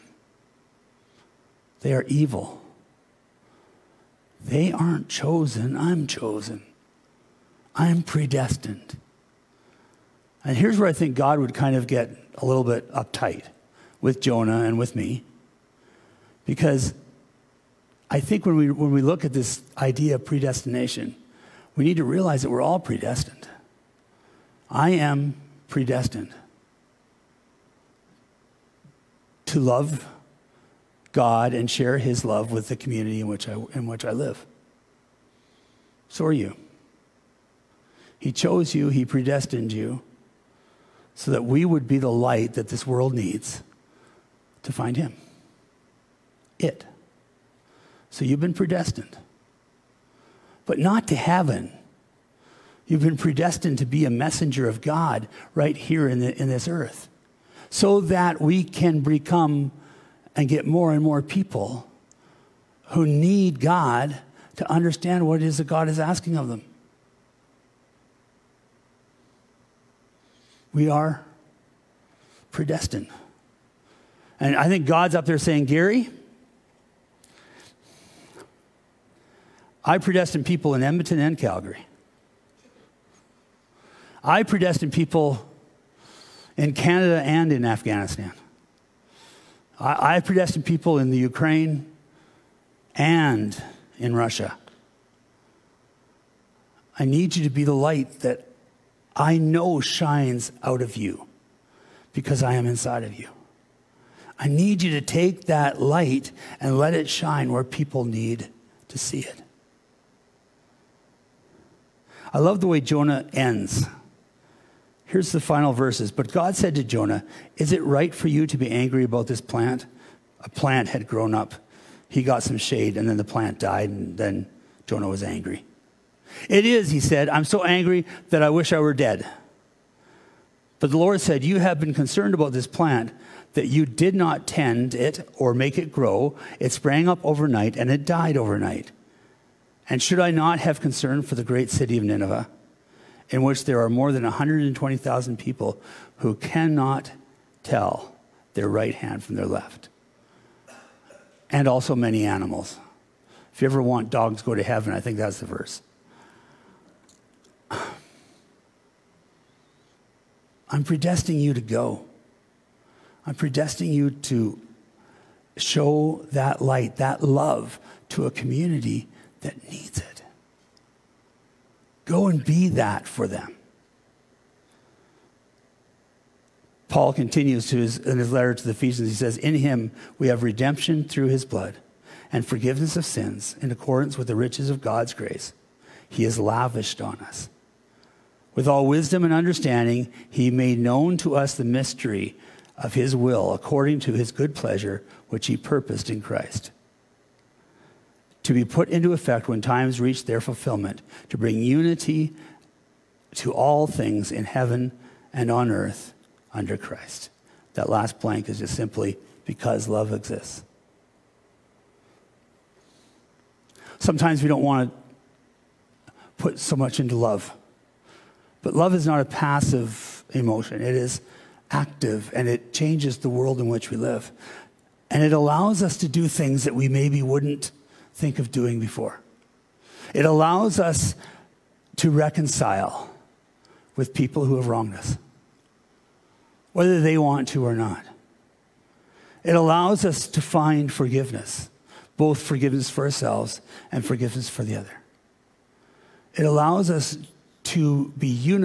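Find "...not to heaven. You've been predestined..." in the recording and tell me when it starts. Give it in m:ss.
0:50.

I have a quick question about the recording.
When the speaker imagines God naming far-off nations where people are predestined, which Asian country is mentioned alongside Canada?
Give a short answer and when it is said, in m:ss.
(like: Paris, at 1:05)
Afghanistan, at 1:27.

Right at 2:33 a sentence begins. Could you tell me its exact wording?
If you ever want dogs go to heaven, I think that's the verse.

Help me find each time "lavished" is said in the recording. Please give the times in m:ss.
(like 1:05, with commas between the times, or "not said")
3:06.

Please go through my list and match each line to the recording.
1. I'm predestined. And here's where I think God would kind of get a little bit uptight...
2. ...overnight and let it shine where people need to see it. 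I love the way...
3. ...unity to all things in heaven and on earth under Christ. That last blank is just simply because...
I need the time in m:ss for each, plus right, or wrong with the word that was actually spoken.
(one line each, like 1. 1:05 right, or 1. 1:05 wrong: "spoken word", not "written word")
1. 0:07 right
2. 1:45 wrong: "light", not "overnight"
3. 3:21 right.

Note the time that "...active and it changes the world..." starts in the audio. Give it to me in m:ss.
3:41.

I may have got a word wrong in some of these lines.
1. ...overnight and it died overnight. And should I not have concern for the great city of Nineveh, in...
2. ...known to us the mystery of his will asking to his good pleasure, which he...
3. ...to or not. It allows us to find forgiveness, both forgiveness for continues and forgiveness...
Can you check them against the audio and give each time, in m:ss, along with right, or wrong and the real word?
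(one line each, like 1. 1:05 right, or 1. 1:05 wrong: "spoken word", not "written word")
1. 2:17 right
2. 3:10 wrong: "according", not "asking"
3. 3:57 wrong: "ourselves", not "continues".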